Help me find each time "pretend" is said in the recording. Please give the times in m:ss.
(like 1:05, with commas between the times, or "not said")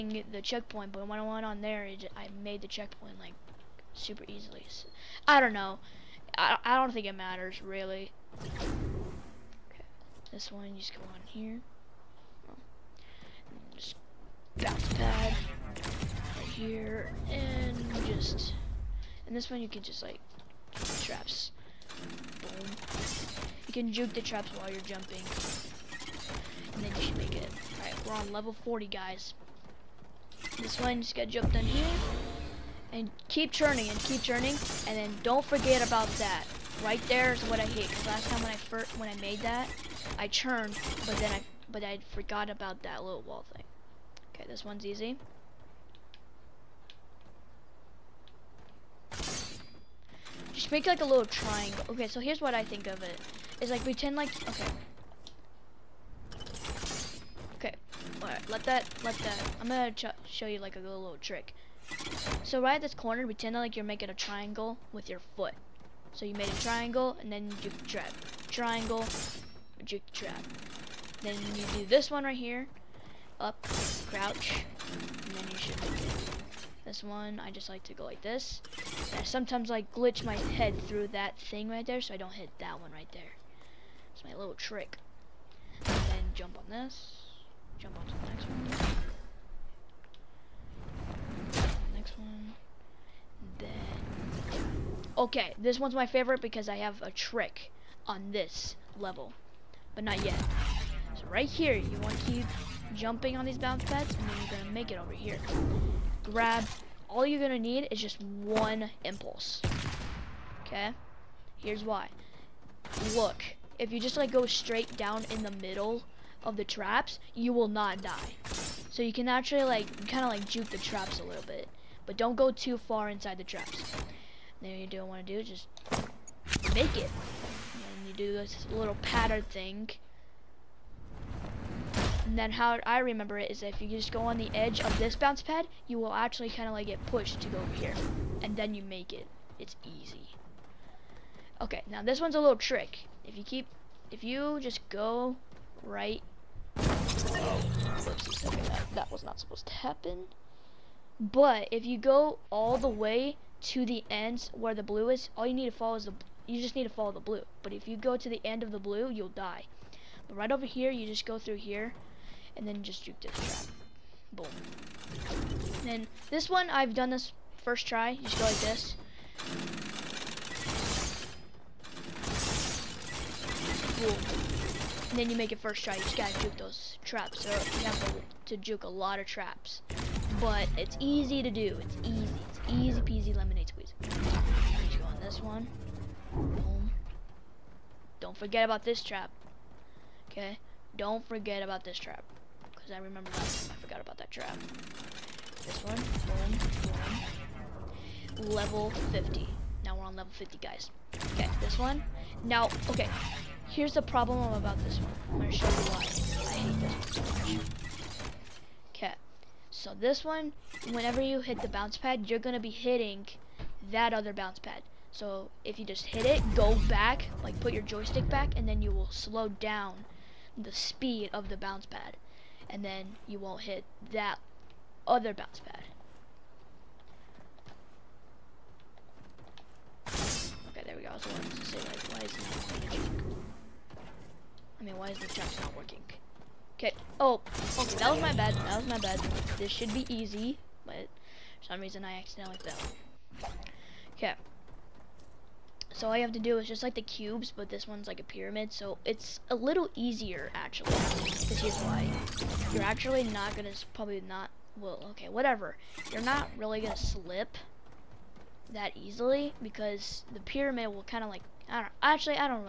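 0:53, 1:03.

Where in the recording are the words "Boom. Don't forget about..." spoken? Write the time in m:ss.
3:06.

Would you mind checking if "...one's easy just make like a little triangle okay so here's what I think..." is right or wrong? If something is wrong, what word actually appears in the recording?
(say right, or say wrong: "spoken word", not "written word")
right.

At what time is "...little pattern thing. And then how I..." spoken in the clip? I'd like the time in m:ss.
2:08.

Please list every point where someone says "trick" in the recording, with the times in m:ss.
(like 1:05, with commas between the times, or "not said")
1:01, 1:24, 1:37, 2:22.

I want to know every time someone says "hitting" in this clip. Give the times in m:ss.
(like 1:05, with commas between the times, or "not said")
3:32.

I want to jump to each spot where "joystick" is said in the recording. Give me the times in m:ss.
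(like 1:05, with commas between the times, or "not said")
3:37.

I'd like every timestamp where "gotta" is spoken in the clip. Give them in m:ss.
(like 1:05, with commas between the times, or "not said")
2:56.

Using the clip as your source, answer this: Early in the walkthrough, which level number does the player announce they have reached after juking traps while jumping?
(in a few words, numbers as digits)
40.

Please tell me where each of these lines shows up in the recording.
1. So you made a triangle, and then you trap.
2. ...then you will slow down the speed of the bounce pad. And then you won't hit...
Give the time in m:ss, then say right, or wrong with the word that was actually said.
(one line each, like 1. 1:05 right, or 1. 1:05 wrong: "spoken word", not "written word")
1. 1:06 right
2. 3:38 right.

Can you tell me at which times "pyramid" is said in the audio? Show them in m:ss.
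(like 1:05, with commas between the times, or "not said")
4:08, 4:20.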